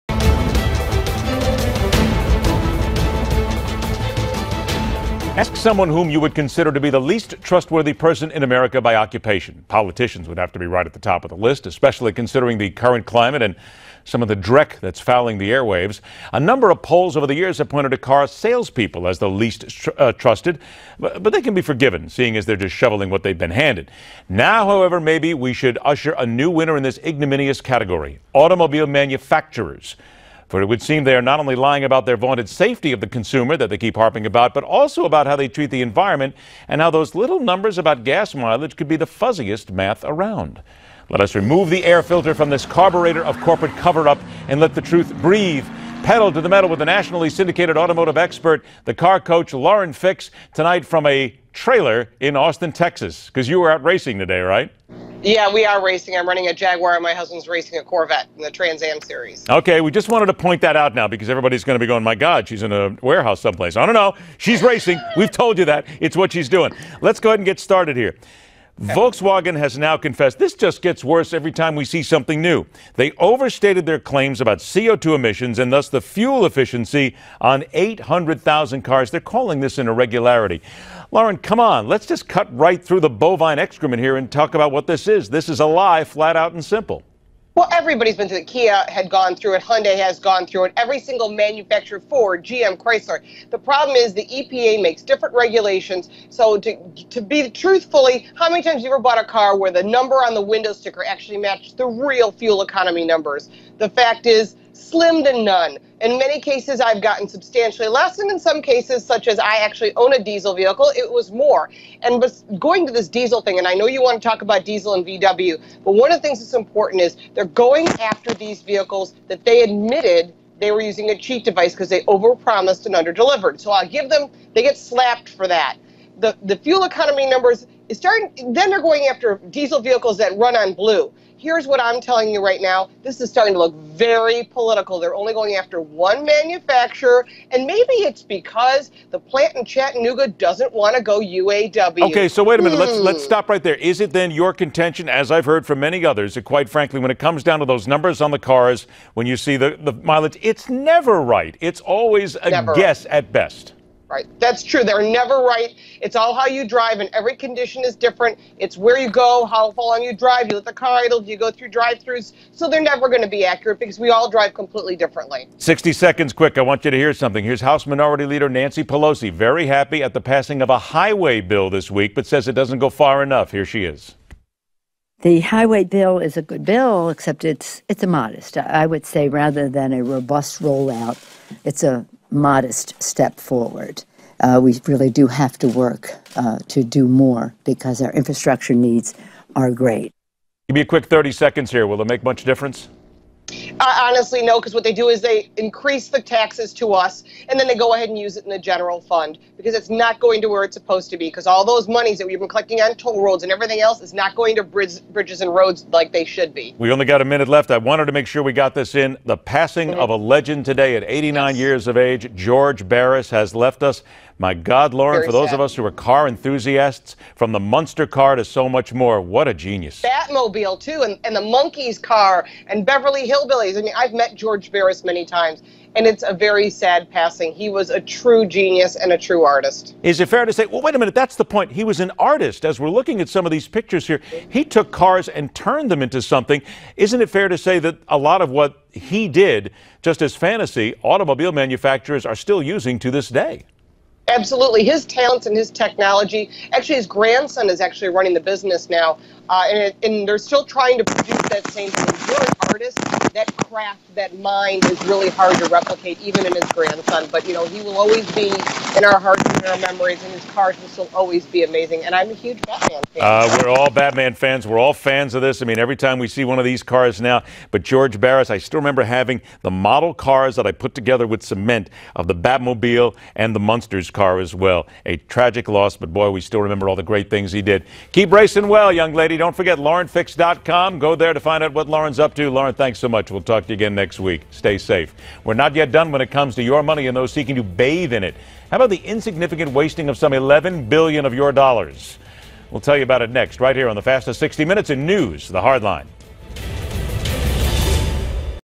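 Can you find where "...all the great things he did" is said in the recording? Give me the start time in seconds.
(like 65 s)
276 s.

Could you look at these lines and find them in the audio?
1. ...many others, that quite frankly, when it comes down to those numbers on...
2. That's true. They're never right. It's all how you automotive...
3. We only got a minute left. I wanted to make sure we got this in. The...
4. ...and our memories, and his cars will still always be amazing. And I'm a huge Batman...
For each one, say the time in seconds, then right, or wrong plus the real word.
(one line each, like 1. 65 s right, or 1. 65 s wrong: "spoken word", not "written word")
1. 145 s right
2. 154 s wrong: "drive", not "automotive"
3. 206 s right
4. 259 s right.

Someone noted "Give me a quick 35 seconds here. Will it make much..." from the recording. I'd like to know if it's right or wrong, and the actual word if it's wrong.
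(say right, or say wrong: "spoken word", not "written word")
wrong: "30", not "35".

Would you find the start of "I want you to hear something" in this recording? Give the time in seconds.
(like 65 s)
166 s.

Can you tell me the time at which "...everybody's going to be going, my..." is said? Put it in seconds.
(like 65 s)
61 s.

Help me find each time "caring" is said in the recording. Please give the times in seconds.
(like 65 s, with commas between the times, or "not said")
not said.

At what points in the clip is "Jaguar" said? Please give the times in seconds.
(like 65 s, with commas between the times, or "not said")
56 s.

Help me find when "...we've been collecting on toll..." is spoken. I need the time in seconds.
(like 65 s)
202 s.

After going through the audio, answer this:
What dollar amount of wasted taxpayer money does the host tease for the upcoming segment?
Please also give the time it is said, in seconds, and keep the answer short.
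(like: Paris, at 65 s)
11 billion, at 290 s.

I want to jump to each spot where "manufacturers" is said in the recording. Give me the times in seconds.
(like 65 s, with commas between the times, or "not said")
28 s, 91 s, 136 s, 241 s.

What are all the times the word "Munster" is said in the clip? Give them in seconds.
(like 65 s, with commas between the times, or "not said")
217 s, 273 s.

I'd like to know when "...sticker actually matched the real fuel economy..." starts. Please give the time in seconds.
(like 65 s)
100 s.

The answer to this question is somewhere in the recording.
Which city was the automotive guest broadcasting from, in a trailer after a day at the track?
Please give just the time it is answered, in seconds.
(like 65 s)
52 s.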